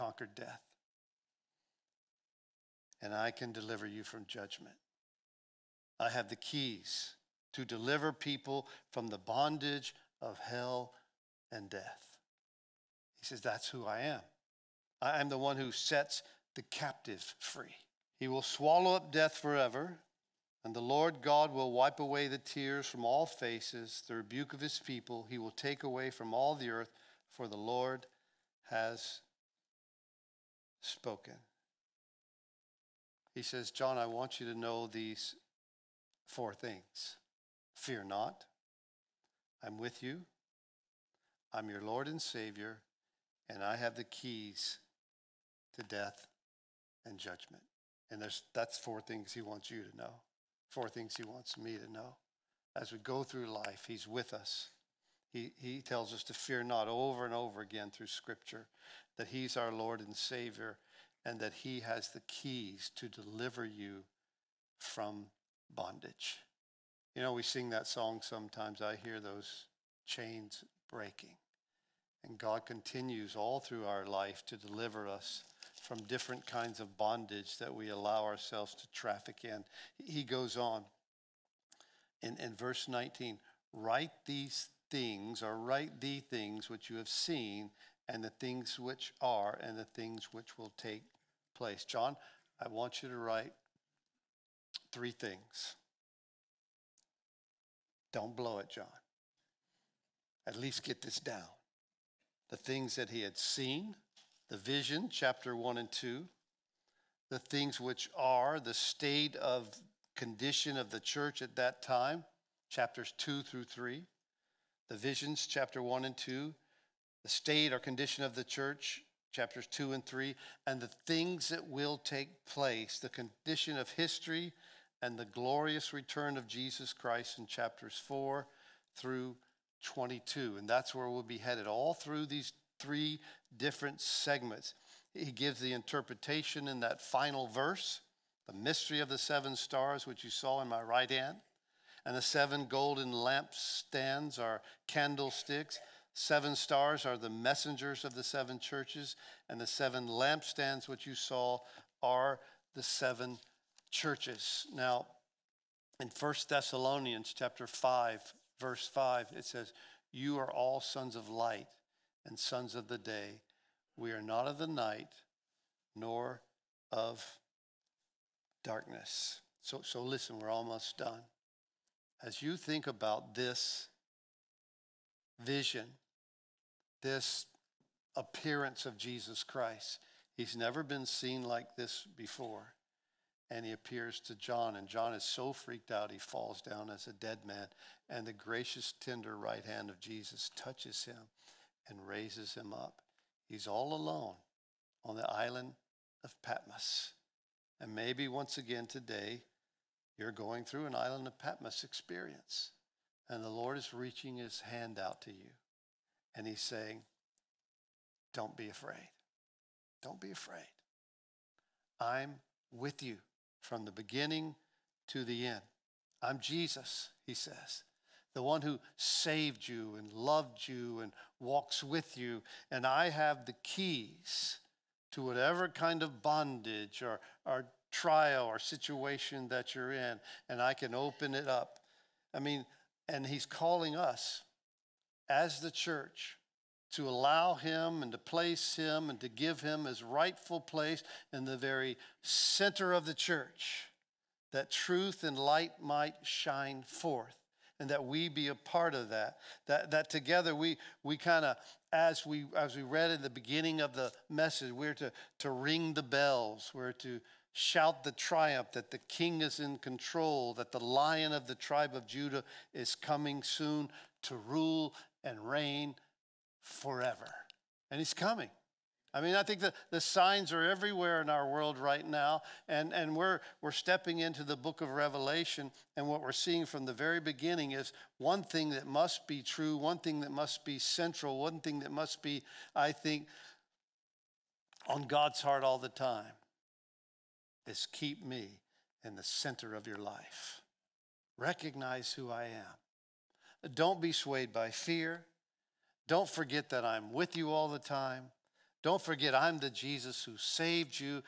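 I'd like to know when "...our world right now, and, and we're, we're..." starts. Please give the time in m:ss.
4:31.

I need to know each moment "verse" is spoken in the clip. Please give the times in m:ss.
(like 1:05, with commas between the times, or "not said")
1:22, 2:17, 2:38.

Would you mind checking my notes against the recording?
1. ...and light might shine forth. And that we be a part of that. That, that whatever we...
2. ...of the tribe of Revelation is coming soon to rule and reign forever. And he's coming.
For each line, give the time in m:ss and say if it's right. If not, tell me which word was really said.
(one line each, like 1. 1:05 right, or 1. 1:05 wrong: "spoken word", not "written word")
1. 4:05 wrong: "together", not "whatever"
2. 4:21 wrong: "Judah", not "Revelation".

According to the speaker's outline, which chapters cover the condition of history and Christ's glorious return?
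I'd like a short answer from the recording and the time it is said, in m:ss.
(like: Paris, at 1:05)
Chapters 4 through 22, at 2:07.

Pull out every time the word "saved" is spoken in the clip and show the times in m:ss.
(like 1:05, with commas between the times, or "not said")
3:38, 5:00.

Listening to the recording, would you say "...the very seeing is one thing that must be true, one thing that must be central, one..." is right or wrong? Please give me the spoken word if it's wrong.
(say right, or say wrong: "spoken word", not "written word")
wrong: "beginning", not "seeing".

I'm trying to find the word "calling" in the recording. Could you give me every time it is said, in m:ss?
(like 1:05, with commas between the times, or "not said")
3:53.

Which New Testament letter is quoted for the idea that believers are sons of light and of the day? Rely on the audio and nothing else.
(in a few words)
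First Thessalonians.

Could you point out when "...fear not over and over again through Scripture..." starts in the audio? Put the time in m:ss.
0:56.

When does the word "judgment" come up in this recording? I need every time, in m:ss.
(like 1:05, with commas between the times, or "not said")
0:04, 0:47.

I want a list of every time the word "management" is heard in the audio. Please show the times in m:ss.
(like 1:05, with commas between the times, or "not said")
not said.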